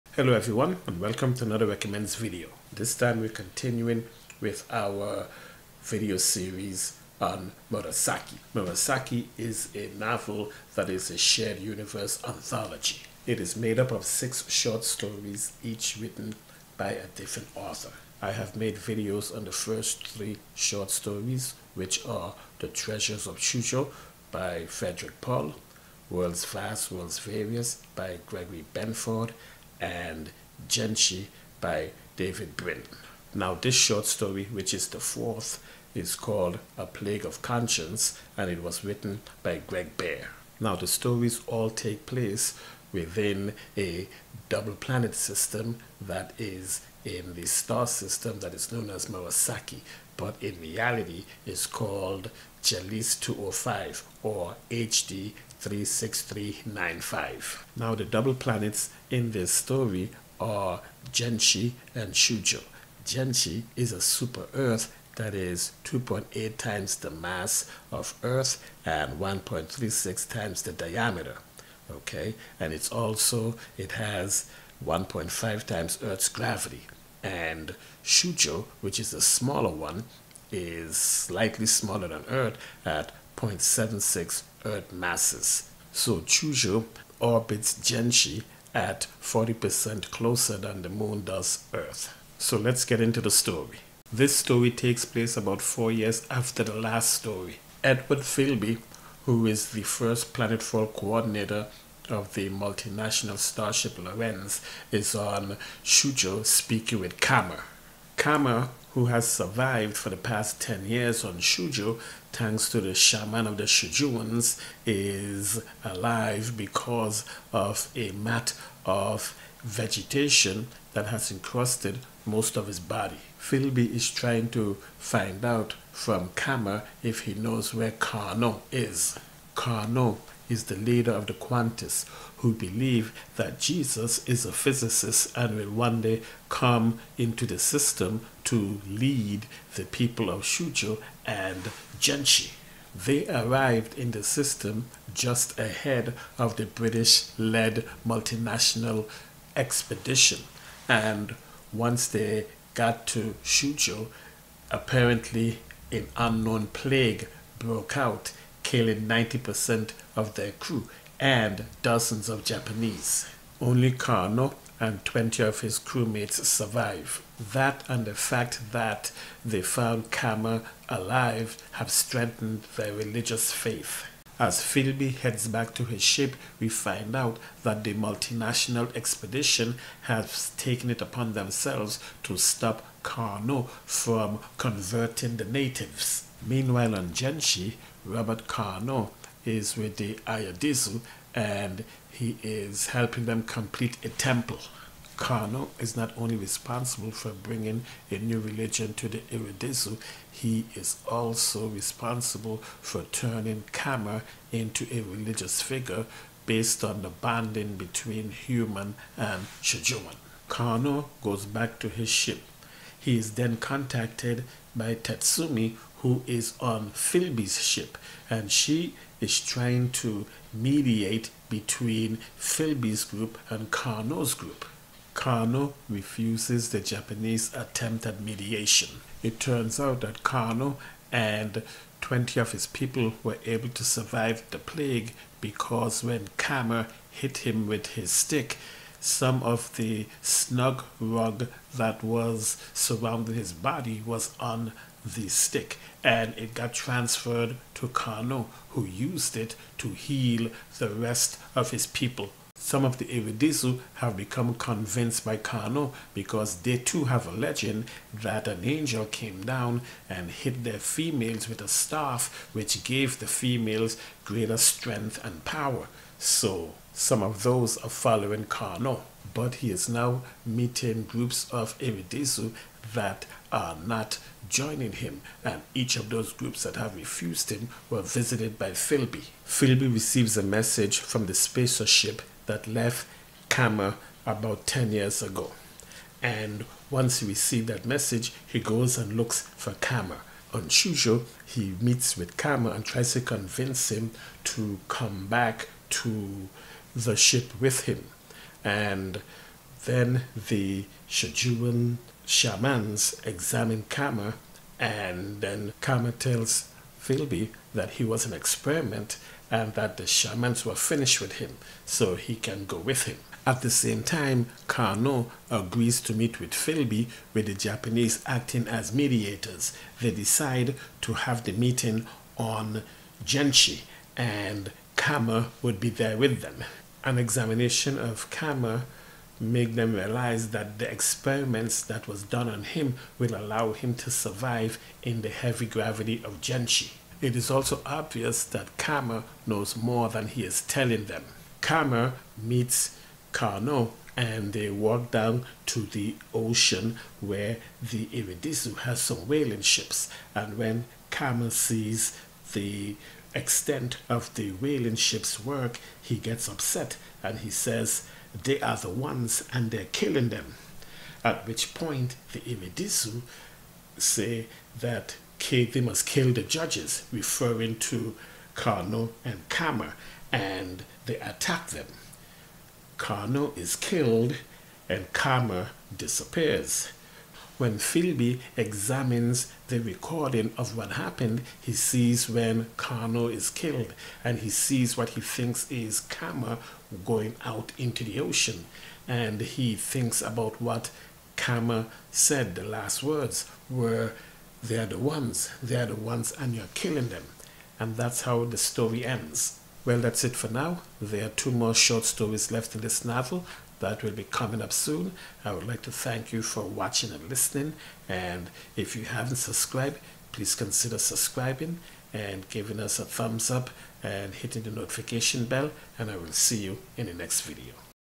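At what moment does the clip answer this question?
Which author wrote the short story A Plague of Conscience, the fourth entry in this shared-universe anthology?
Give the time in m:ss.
0:39.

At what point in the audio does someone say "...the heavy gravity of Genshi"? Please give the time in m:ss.
5:35.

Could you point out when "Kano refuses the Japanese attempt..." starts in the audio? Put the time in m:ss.
3:45.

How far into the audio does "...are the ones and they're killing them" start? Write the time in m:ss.
5:58.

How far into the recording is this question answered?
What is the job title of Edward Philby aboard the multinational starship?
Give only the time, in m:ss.
1:39.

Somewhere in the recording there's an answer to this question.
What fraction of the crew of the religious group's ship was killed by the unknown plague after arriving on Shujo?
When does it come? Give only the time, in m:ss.
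2:39.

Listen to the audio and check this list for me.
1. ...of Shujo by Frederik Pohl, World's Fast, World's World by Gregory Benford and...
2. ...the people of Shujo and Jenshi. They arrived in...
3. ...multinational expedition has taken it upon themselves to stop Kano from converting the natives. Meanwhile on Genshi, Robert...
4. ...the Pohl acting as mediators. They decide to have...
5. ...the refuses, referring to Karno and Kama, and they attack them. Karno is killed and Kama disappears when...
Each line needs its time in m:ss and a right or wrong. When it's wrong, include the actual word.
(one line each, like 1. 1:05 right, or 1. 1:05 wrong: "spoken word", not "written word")
1. 0:23 wrong: "Various", not "World"
2. 2:19 right
3. 2:57 right
4. 5:17 wrong: "Japanese", not "Pohl"
5. 6:06 wrong: "judges", not "refuses".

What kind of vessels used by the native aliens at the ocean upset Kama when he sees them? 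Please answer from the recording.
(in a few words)
whaling ships.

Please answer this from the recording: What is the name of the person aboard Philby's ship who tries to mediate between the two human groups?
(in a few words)
Tatsumi.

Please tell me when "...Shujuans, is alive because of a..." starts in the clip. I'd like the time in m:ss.
1:53.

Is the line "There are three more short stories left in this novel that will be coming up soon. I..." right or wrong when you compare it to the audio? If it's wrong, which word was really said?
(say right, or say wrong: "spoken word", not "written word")
wrong: "two", not "three".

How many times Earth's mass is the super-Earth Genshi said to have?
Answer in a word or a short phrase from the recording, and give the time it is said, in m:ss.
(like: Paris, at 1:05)
2.8, at 1:05.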